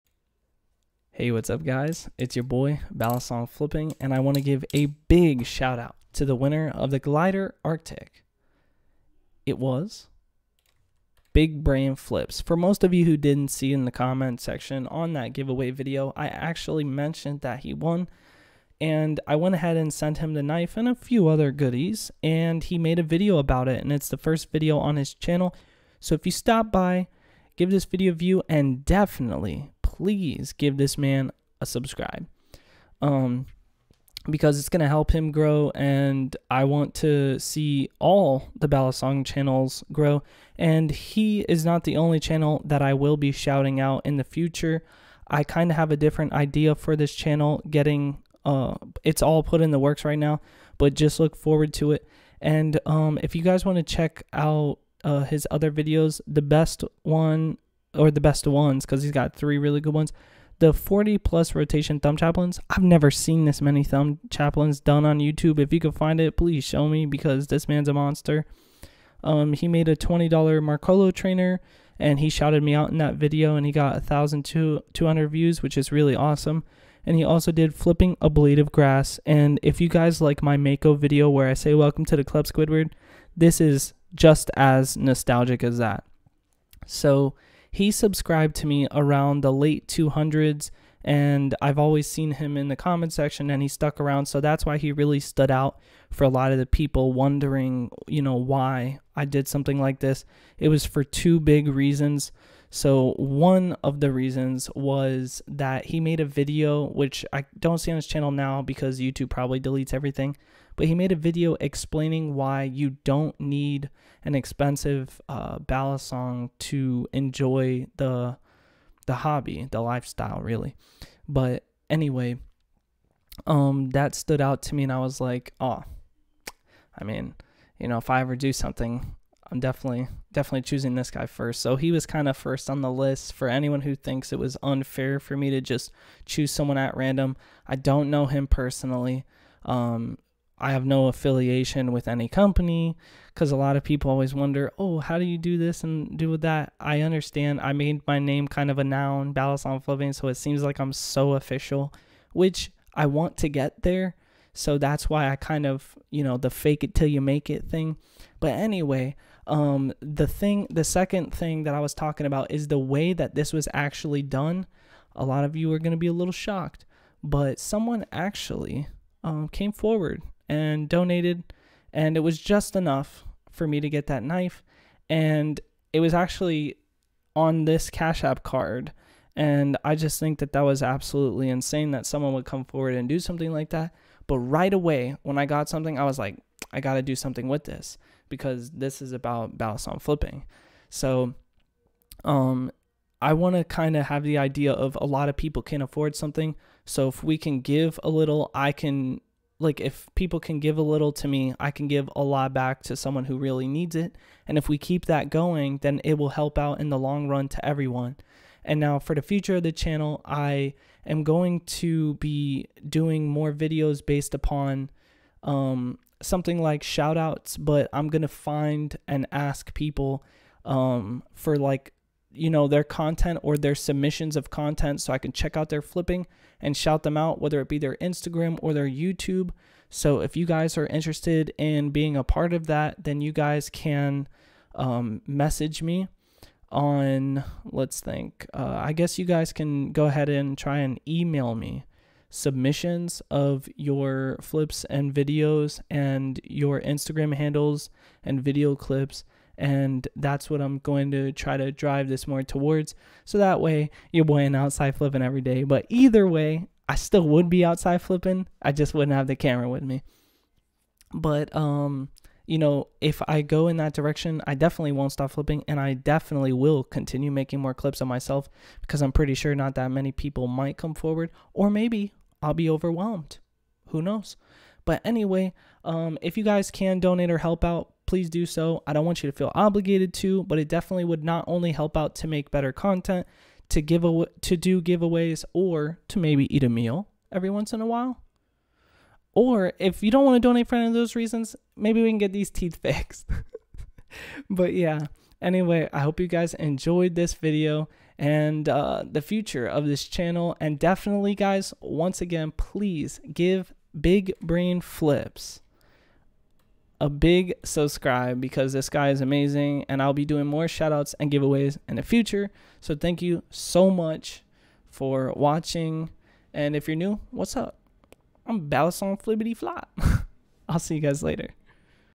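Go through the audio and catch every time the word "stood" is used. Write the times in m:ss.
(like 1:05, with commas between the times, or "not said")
1:35, 2:04.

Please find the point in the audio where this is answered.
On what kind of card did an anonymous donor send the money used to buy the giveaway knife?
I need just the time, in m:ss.
2:57.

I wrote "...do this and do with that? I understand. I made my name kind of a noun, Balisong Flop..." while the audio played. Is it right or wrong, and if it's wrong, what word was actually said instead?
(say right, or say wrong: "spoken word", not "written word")
wrong: "Flipping", not "Flop".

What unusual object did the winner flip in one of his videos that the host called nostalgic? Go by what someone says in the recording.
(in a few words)
a blade of grass.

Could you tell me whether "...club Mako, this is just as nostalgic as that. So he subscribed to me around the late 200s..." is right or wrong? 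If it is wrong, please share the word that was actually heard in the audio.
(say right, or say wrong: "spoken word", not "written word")
wrong: "Squidward", not "Mako".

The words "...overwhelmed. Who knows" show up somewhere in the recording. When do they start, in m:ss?
4:32.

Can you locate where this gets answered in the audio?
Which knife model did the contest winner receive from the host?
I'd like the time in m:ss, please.
0:06.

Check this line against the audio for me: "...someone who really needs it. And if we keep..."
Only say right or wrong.
right.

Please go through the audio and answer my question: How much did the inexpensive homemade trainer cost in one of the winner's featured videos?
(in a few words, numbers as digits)
$20.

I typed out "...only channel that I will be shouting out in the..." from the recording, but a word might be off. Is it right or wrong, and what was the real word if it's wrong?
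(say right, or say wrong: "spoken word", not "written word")
right.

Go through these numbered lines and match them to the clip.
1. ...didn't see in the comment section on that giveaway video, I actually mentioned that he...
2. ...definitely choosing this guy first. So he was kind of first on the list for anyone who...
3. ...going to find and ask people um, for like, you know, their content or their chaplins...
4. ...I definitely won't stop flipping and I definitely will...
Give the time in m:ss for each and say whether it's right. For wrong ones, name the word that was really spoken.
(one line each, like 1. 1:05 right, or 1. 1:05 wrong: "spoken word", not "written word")
1. 0:13 right
2. 2:10 right
3. 3:38 wrong: "submissions", not "chaplins"
4. 4:24 right.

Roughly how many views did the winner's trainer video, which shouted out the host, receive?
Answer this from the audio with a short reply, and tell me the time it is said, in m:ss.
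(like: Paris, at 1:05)
1,200, at 1:14.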